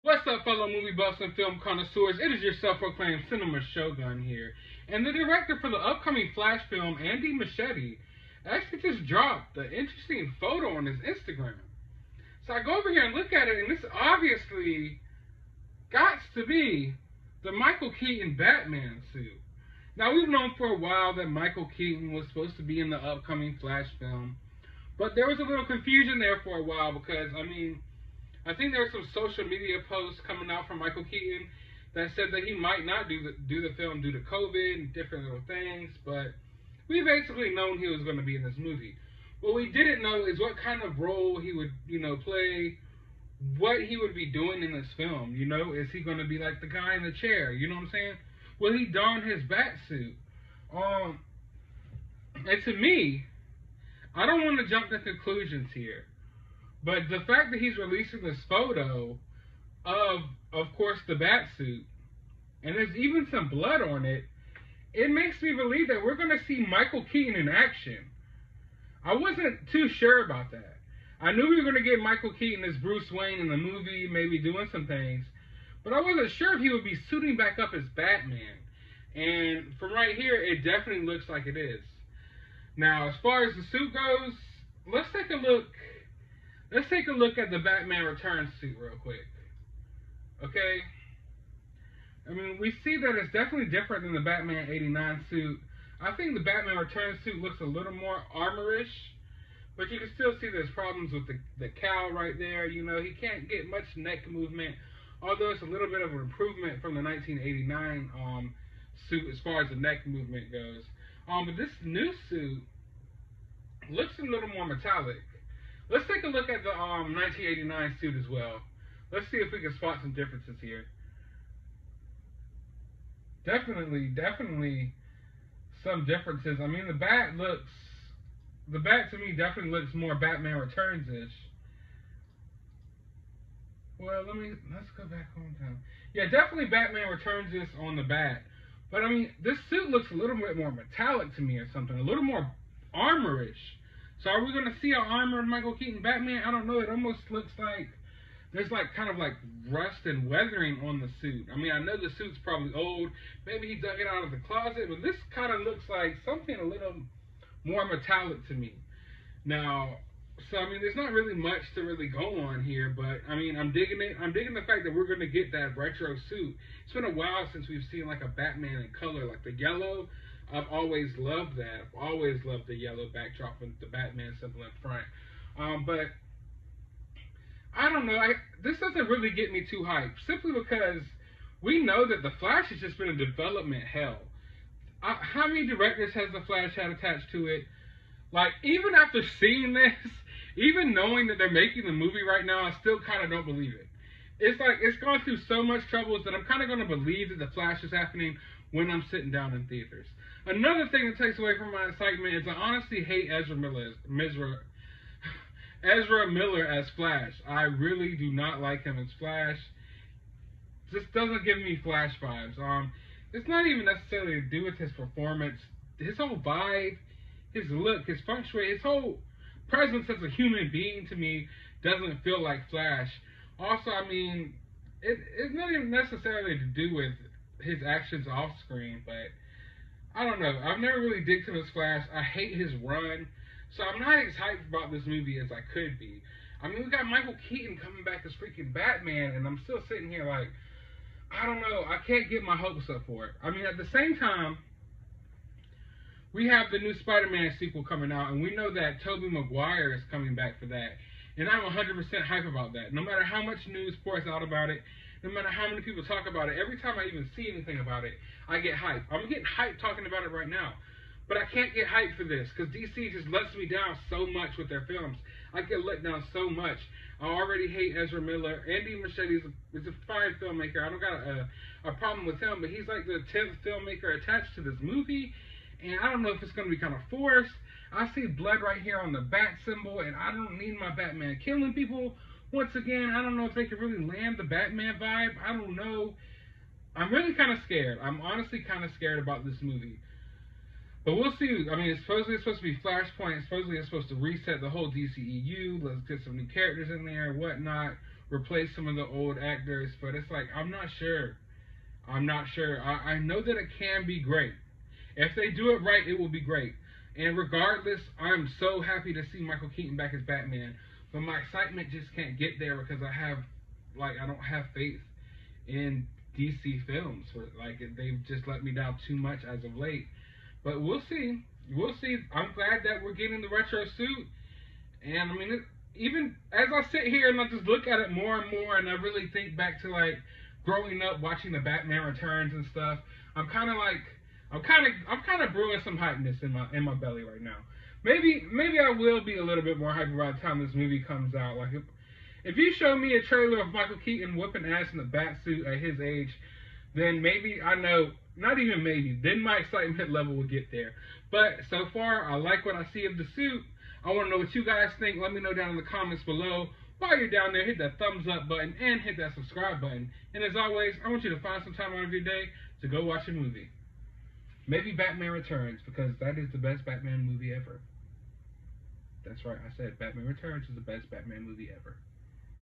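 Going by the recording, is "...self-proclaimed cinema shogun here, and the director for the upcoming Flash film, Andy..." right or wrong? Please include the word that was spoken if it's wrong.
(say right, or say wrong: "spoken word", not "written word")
right.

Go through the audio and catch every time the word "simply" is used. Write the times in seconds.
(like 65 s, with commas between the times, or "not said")
180 s.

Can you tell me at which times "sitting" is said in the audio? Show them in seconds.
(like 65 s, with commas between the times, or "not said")
199 s, 239 s.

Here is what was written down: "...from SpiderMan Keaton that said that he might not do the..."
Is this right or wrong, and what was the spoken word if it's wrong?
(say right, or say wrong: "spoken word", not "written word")
wrong: "Michael", not "SpiderMan".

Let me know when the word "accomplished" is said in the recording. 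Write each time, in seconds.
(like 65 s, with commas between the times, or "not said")
not said.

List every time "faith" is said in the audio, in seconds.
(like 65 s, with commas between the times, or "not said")
314 s.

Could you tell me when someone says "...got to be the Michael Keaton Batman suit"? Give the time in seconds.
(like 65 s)
15 s.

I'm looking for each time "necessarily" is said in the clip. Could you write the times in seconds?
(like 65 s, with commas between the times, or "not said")
213 s, 225 s.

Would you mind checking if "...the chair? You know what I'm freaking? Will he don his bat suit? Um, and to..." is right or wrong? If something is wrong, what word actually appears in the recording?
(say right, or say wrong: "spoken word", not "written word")
wrong: "saying", not "freaking".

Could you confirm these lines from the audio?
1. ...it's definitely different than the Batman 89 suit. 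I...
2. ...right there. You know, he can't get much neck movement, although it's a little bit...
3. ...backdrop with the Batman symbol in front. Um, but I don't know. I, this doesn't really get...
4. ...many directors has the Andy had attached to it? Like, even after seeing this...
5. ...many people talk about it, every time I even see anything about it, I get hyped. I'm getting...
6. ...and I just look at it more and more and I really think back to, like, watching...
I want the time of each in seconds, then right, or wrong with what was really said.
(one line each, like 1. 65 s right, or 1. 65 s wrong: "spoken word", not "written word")
1. 93 s right
2. 102 s right
3. 173 s right
4. 185 s wrong: "Flash", not "Andy"
5. 255 s right
6. 327 s wrong: "growing", not "watching".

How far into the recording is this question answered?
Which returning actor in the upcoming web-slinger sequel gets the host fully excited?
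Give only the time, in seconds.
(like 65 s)
249 s.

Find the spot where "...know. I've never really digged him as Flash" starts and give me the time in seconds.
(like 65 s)
230 s.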